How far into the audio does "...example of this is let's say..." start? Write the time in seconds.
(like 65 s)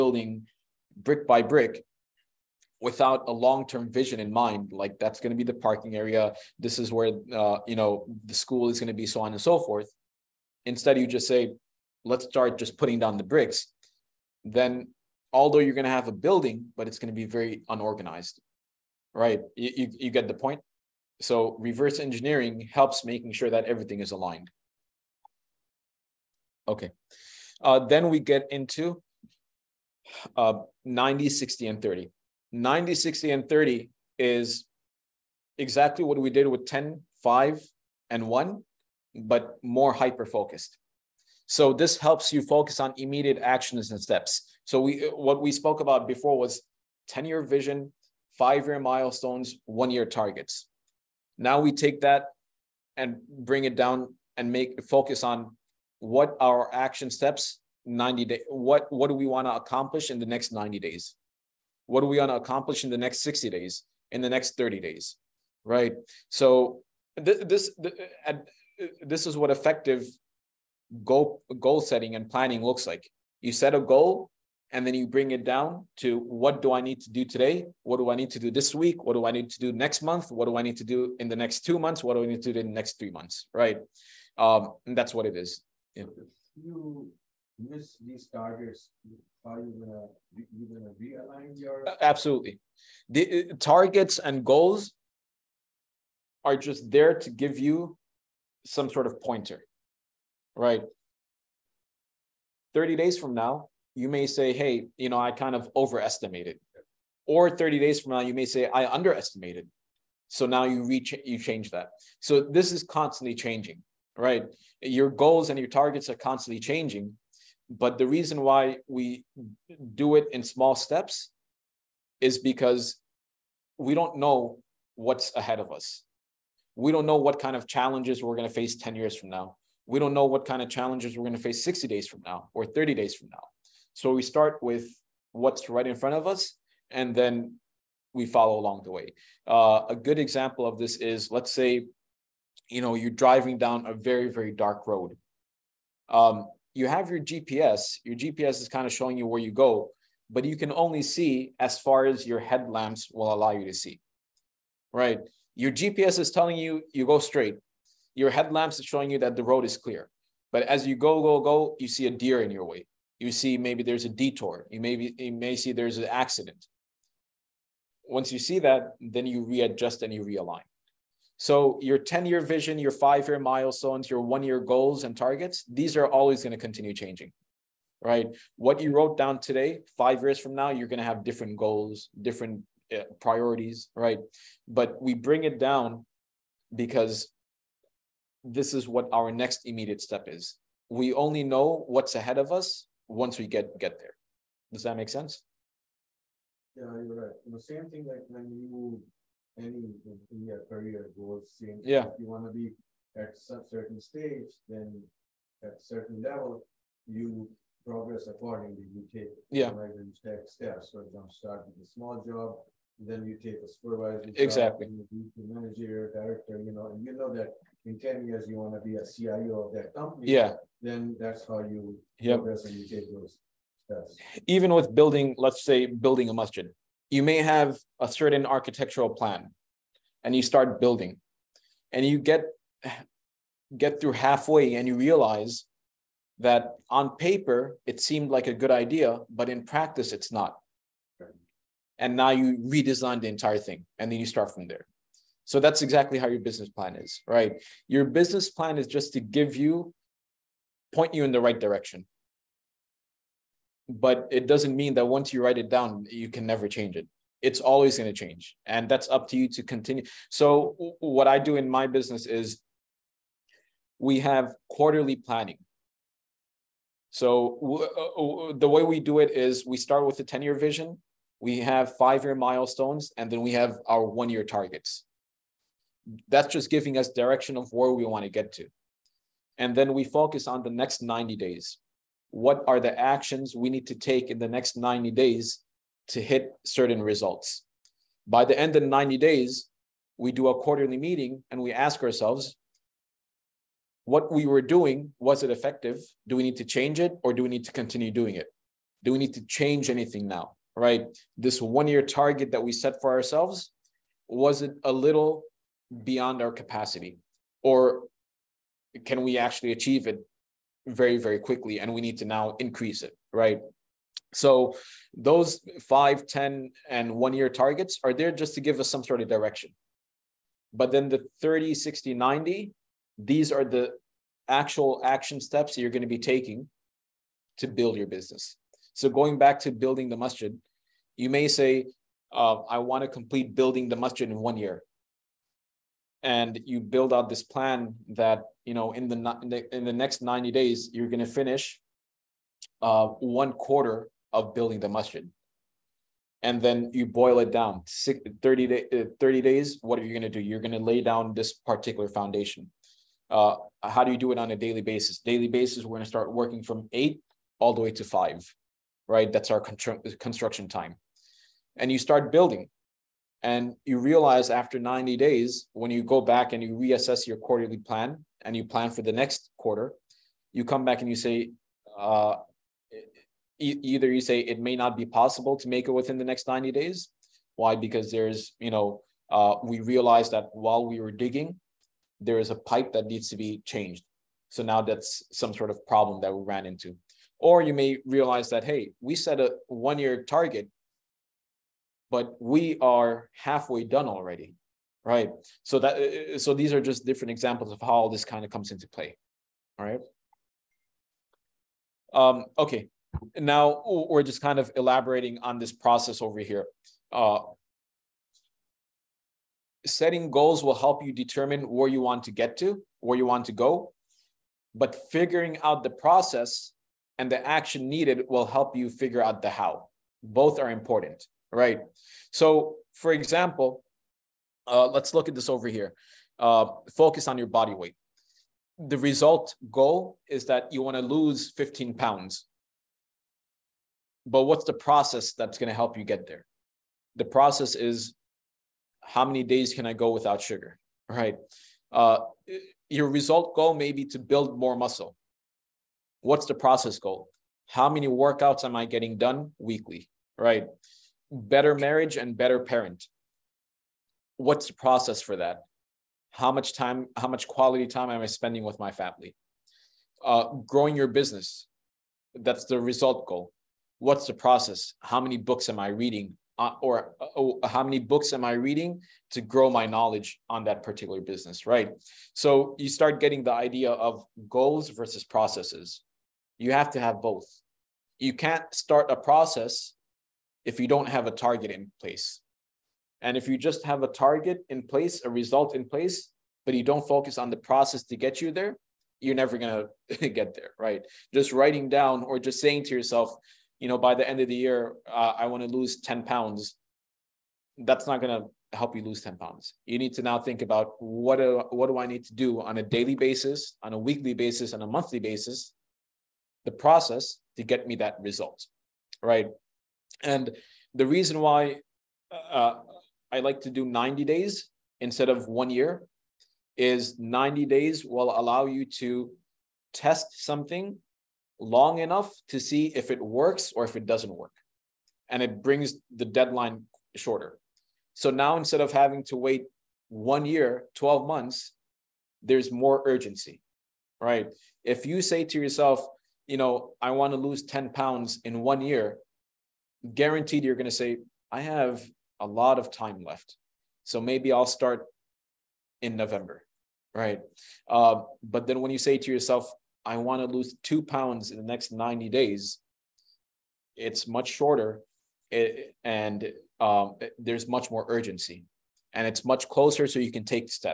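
140 s.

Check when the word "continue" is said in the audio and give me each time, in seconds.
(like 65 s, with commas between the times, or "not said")
176 s, 259 s, 297 s.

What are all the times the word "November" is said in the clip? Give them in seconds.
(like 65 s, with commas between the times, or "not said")
546 s.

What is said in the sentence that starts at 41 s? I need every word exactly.
So this helps you focus on immediate actions and steps.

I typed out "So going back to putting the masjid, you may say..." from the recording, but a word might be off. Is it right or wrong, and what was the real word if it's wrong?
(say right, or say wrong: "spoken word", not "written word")
wrong: "building", not "putting".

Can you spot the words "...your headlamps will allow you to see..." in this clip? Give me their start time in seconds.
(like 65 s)
152 s.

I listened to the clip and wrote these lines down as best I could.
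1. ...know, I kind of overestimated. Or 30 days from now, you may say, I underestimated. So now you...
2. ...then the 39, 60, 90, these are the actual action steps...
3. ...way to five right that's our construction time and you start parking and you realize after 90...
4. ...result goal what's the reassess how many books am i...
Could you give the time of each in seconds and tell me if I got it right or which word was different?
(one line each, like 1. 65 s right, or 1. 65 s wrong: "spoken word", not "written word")
1. 105 s right
2. 320 s wrong: "30", not "39"
3. 357 s wrong: "building", not "parking"
4. 462 s wrong: "process", not "reassess".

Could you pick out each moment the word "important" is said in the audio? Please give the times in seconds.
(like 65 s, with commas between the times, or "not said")
420 s.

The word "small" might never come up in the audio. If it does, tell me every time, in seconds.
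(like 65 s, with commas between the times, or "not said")
120 s, 211 s.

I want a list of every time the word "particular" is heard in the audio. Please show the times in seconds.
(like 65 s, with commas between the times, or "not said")
351 s, 470 s.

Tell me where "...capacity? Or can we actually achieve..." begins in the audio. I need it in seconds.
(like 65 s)
306 s.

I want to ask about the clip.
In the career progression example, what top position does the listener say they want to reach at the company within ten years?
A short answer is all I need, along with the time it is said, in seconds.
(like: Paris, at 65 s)
CIO, at 219 s.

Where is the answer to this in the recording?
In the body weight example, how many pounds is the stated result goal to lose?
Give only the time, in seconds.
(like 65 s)
431 s.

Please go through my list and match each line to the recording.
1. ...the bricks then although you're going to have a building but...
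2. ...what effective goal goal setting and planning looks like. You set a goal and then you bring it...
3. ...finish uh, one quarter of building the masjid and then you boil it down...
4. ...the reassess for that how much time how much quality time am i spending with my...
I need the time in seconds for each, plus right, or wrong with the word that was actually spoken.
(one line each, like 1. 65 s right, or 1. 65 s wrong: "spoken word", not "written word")
1. 13 s right
2. 69 s right
3. 341 s right
4. 454 s wrong: "process", not "reassess".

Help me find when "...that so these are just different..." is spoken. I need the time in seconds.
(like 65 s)
395 s.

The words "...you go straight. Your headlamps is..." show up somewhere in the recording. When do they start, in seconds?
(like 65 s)
156 s.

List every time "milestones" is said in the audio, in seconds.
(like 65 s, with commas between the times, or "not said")
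48 s, 173 s, 272 s.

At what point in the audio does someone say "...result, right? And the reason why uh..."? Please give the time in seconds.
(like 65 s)
508 s.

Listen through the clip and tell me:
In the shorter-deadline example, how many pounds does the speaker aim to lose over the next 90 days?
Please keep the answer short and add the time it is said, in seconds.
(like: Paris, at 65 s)
2, at 550 s.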